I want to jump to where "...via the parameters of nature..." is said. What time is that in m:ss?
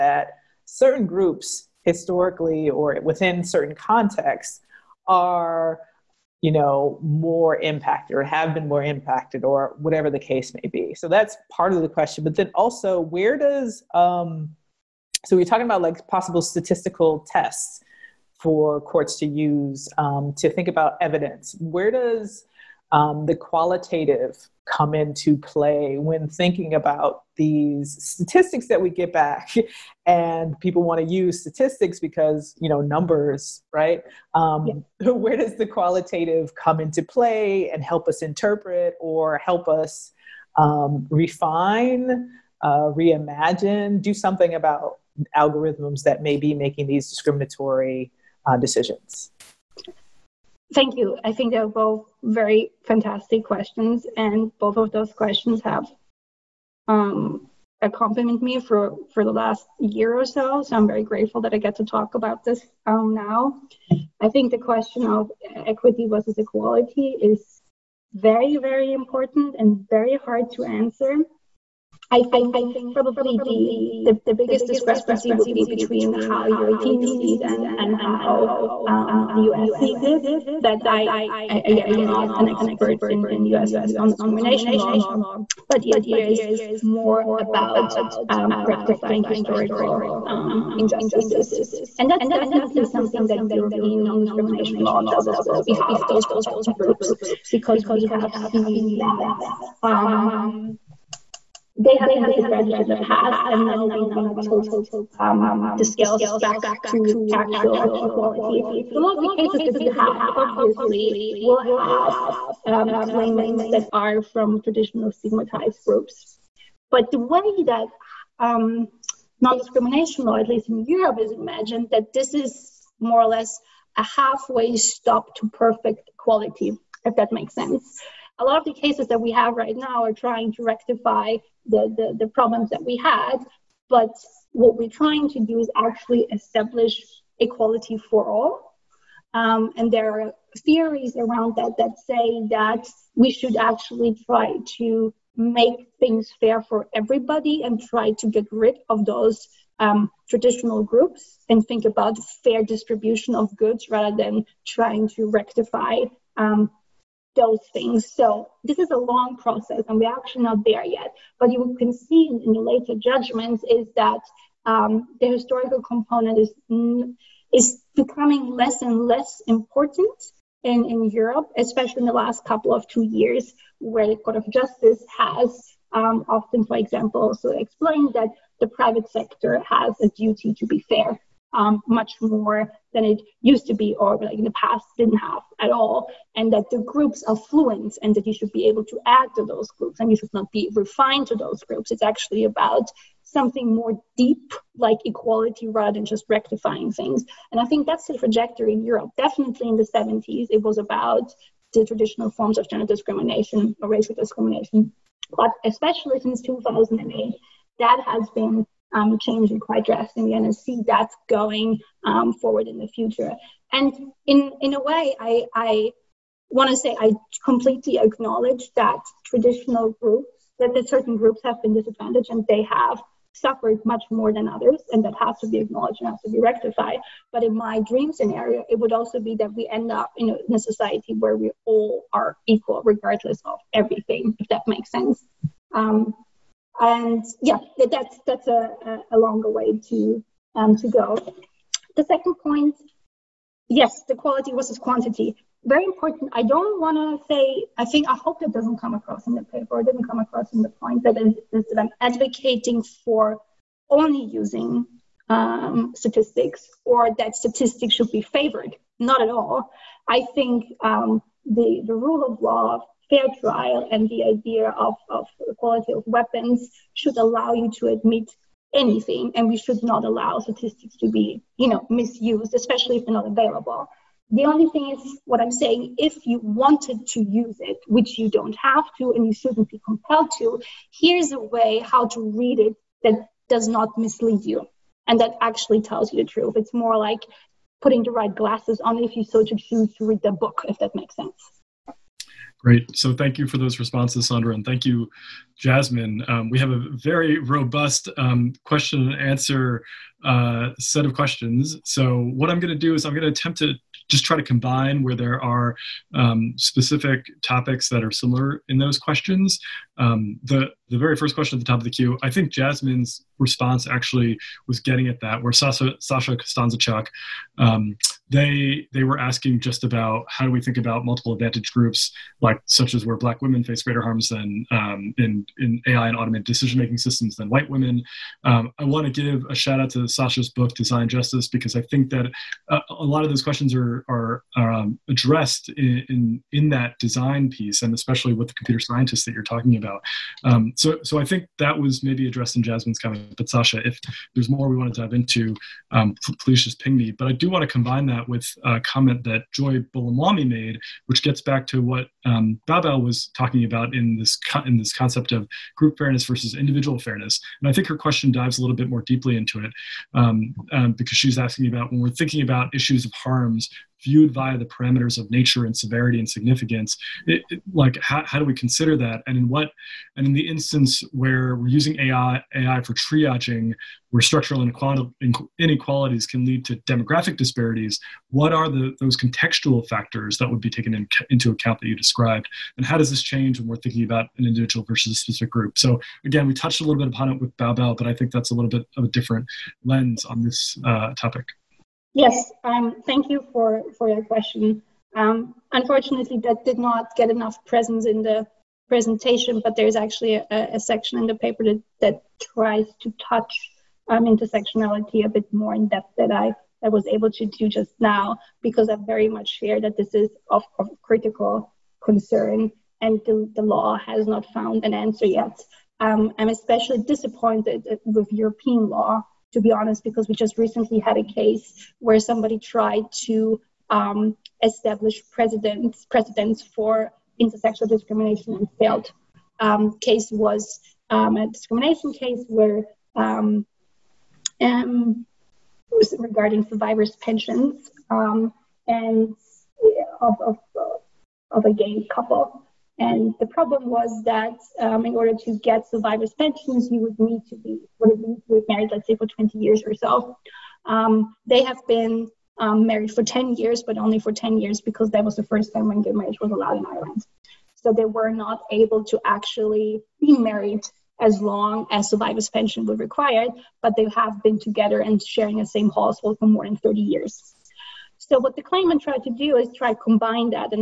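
6:04.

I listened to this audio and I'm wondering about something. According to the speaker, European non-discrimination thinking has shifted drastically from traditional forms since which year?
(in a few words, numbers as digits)
2008.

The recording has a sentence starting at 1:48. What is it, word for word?
So a lot of the cases that you have obviously will have um, claimants that are from traditional stigmatized groups.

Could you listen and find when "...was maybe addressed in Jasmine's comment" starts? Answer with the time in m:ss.
5:41.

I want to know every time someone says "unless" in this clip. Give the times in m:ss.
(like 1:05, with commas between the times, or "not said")
not said.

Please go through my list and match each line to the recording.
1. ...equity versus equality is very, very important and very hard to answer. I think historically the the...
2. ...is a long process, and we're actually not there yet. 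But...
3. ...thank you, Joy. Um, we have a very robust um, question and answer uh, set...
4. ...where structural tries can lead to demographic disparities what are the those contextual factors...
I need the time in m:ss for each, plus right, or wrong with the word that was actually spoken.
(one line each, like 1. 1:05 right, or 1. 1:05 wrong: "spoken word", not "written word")
1. 1:05 wrong: "probably", not "historically"
2. 2:38 right
3. 4:54 wrong: "Jasmine", not "Joy"
4. 6:14 wrong: "inequalities", not "tries".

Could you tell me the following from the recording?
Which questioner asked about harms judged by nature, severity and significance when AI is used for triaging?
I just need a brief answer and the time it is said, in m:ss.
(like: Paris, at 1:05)
Joy Buolamwini, at 5:49.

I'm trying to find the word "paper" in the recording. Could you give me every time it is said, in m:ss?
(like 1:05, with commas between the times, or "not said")
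4:09, 6:41.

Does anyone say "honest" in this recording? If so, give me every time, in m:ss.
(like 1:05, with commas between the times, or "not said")
6:59.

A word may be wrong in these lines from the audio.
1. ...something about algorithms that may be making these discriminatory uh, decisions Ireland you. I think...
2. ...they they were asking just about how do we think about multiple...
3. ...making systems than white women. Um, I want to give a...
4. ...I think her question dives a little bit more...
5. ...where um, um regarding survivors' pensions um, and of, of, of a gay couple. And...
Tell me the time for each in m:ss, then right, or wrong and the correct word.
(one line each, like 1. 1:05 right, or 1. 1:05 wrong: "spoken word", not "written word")
1. 0:44 wrong: "Thank", not "Ireland"
2. 5:18 right
3. 5:26 right
4. 5:57 right
5. 7:12 right.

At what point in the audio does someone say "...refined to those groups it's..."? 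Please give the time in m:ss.
3:10.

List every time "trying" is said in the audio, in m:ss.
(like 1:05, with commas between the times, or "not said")
2:10, 2:14, 2:34.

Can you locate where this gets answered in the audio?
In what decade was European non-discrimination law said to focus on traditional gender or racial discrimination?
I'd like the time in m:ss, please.
3:19.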